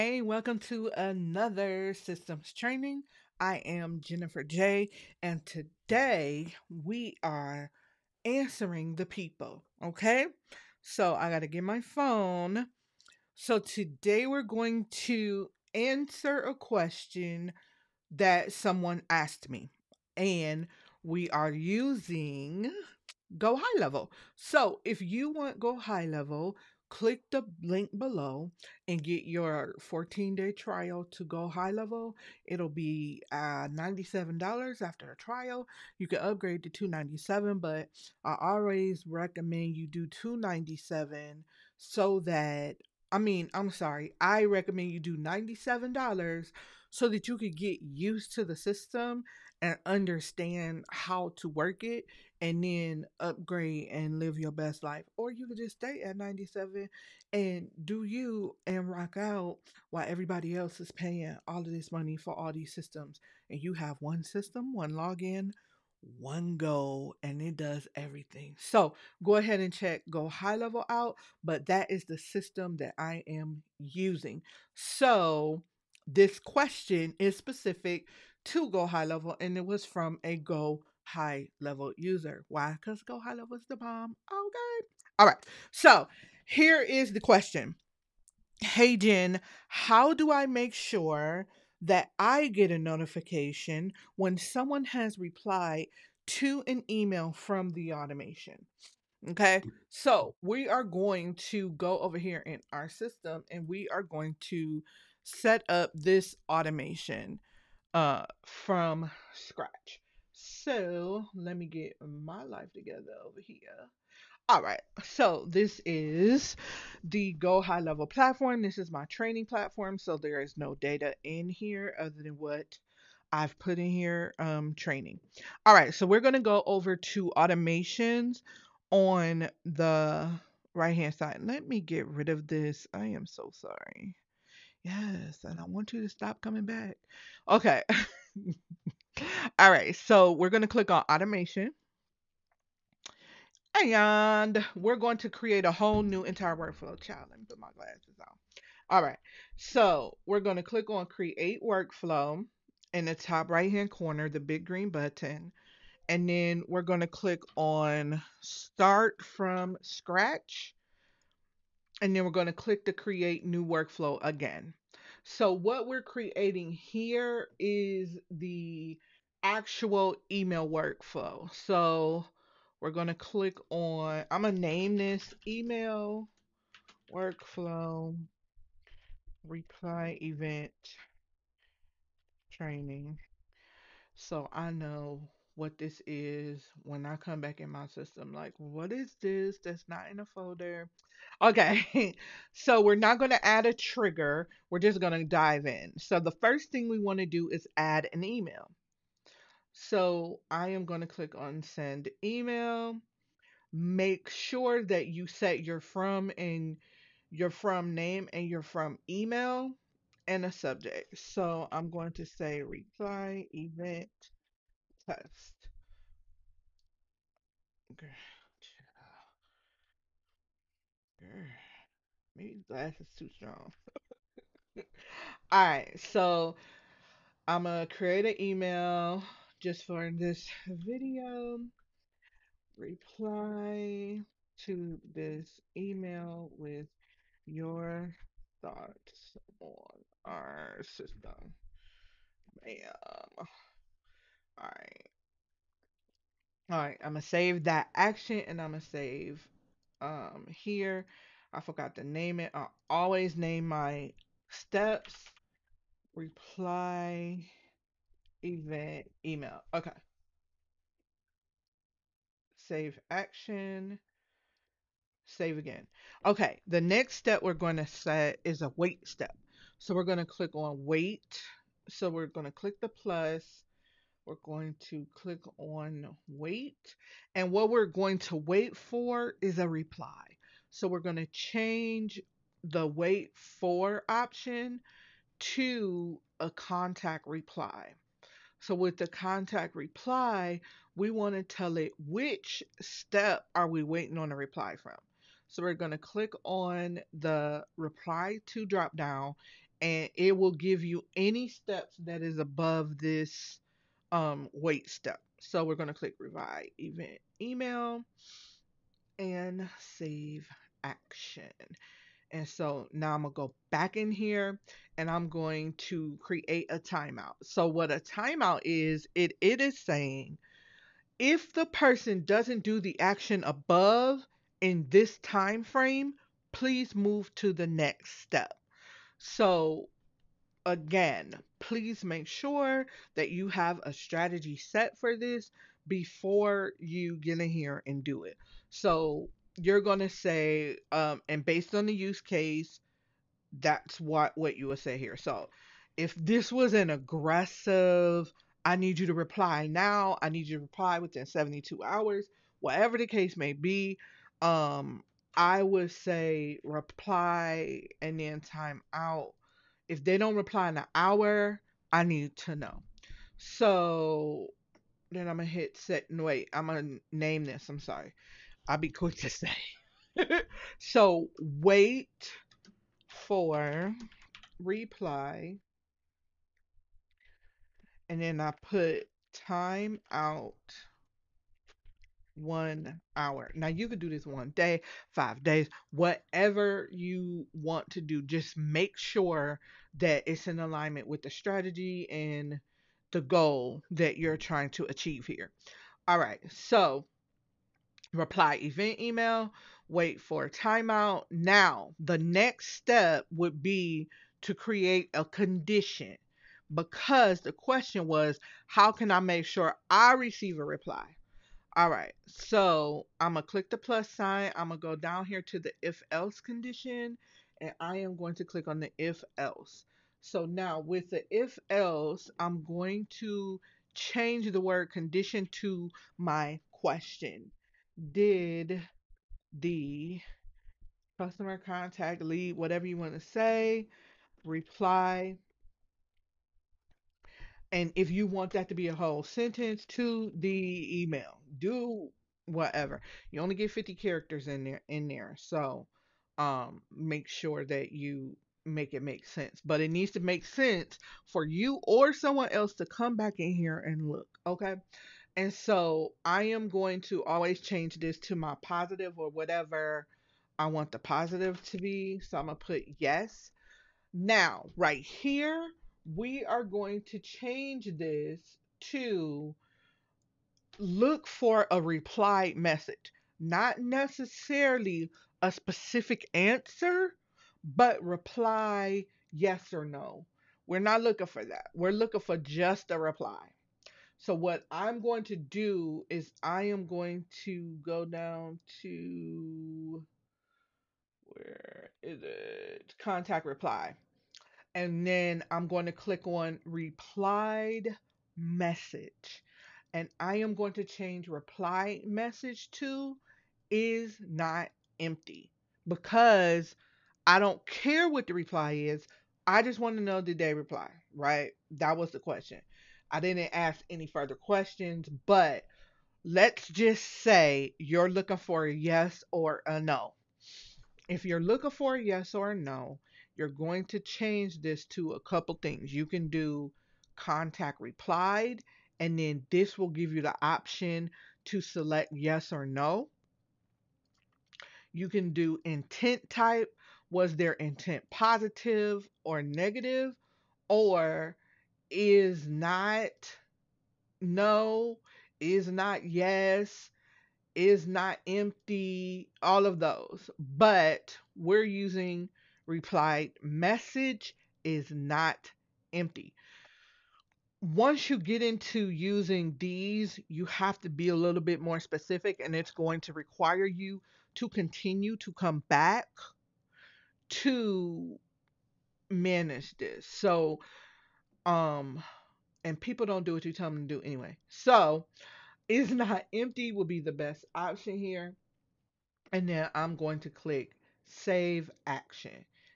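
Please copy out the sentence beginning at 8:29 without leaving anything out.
I just want to know did they reply, right?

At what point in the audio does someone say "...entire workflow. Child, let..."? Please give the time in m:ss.
2:26.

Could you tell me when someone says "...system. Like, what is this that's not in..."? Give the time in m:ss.
3:07.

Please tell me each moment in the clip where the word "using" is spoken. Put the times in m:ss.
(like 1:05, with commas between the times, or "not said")
0:21, 1:13, 9:11, 9:18.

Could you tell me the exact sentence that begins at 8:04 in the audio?
So what I'm going to do is I am going to go down to where is it?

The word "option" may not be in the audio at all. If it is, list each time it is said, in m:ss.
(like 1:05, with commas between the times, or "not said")
4:44, 8:50, 9:37.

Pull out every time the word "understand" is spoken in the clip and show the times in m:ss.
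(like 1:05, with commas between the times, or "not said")
0:49.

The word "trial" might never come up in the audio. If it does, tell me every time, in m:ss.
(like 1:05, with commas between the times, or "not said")
0:30, 0:35.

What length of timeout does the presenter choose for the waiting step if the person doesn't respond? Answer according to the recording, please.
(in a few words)
one hour.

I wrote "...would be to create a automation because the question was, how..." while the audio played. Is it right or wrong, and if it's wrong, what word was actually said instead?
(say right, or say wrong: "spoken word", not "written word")
wrong: "condition", not "automation".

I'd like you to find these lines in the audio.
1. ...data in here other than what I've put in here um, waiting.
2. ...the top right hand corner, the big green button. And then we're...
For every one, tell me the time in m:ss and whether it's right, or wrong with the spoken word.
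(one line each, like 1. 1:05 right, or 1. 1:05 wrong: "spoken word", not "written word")
1. 2:00 wrong: "training", not "waiting"
2. 2:33 right.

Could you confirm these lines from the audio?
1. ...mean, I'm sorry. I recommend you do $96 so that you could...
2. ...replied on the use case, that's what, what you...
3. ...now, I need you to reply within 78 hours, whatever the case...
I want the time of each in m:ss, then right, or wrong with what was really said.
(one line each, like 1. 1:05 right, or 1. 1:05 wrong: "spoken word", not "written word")
1. 0:43 wrong: "97", not "96"
2. 5:41 wrong: "based", not "replied"
3. 5:49 wrong: "72", not "78".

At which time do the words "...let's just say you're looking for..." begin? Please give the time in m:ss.
8:36.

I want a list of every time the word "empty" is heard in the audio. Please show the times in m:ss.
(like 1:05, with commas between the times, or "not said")
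8:25, 9:08, 9:15, 9:36.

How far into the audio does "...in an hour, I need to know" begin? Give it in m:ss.
6:00.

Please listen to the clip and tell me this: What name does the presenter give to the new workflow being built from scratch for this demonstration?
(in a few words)
email workflow reply event training.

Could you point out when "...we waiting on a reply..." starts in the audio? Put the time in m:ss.
4:53.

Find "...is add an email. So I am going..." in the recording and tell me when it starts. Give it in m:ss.
3:17.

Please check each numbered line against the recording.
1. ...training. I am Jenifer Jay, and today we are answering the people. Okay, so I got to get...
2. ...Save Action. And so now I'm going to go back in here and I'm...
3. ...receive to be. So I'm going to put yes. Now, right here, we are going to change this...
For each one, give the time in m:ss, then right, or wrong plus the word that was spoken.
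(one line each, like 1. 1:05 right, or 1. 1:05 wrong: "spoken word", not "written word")
1. 0:02 right
2. 5:09 right
3. 7:40 wrong: "positive", not "receive".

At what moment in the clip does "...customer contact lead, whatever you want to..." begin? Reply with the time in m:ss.
7:11.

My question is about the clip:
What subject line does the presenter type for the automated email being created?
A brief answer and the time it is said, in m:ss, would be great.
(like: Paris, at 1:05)
reply event test, at 3:32.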